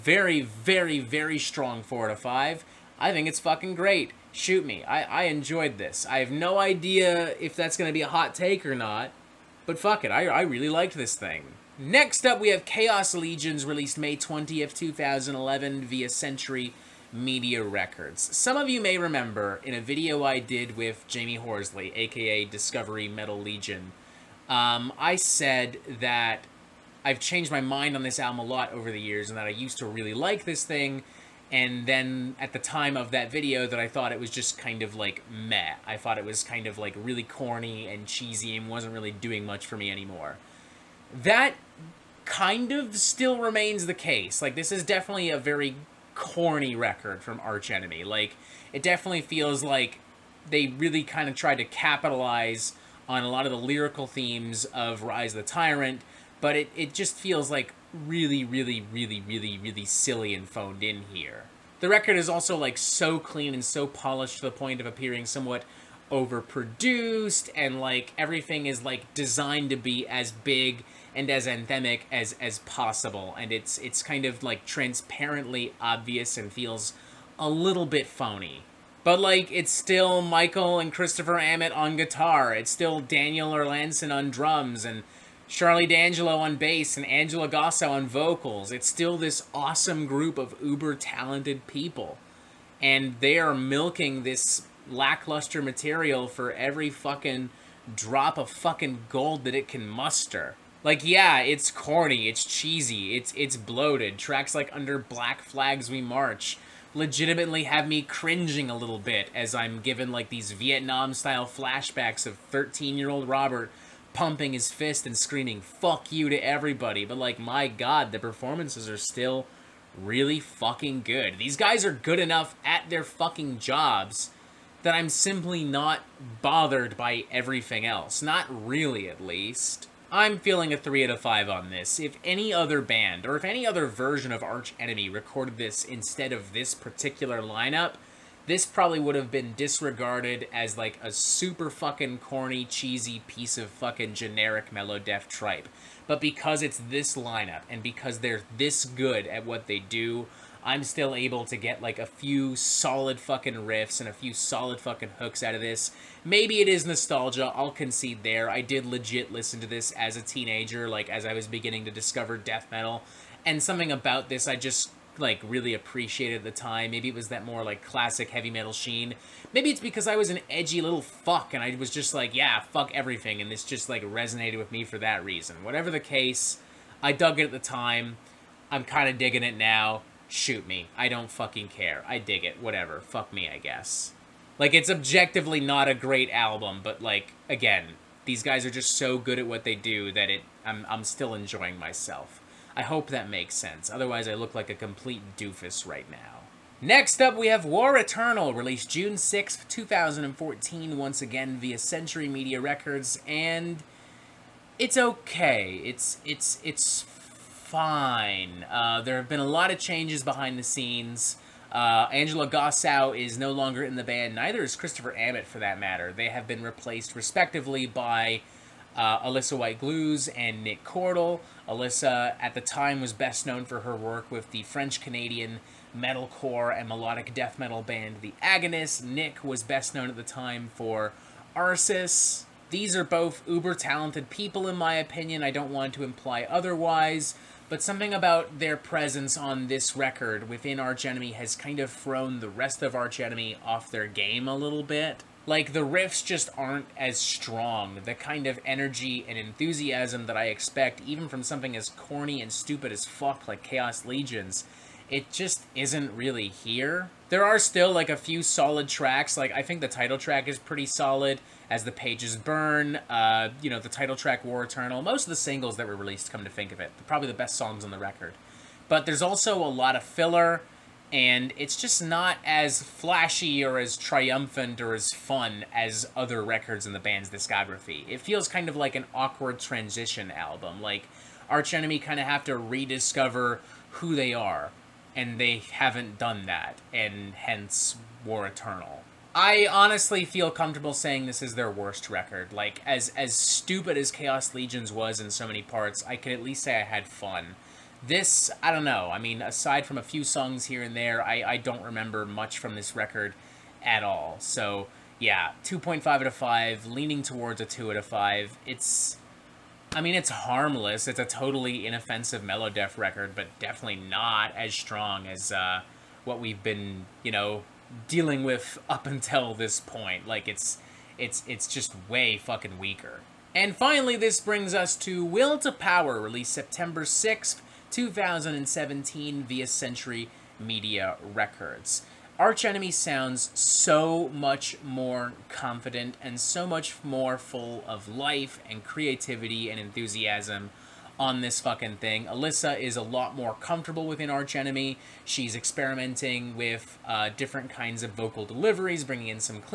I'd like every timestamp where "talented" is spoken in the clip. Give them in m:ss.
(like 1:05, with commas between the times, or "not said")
1:30, 3:53.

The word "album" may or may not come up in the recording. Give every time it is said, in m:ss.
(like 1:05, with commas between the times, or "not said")
0:28, 3:06, 4:40.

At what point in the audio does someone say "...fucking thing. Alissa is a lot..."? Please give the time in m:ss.
5:41.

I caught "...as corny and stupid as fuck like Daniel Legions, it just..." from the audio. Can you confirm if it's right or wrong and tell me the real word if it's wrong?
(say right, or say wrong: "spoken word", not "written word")
wrong: "Khaos", not "Daniel".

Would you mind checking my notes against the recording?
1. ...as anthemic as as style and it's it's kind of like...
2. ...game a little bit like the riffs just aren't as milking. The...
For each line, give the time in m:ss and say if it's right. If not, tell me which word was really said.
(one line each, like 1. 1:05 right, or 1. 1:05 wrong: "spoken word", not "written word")
1. 1:11 wrong: "possible", not "style"
2. 4:04 wrong: "strong", not "milking".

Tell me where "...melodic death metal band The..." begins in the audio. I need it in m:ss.
3:46.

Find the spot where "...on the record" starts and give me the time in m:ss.
4:27.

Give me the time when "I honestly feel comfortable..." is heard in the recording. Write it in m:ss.
4:49.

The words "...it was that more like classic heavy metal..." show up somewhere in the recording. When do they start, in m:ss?
2:47.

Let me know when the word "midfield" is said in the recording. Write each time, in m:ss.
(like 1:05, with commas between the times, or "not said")
not said.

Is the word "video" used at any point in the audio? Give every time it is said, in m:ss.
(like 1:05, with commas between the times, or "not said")
0:19, 0:33.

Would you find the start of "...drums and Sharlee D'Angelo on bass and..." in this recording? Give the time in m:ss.
1:24.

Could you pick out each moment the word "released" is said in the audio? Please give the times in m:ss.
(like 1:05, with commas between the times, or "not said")
0:13, 3:18, 4:25, 5:26.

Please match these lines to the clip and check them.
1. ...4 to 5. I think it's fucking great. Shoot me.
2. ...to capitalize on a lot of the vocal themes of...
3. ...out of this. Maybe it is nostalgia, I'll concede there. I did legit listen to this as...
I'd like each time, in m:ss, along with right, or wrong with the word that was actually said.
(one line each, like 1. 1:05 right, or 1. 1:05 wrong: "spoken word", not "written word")
1. 0:01 right
2. 0:51 wrong: "lyrical", not "vocal"
3. 2:35 right.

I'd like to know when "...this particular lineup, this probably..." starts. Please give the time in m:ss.
2:16.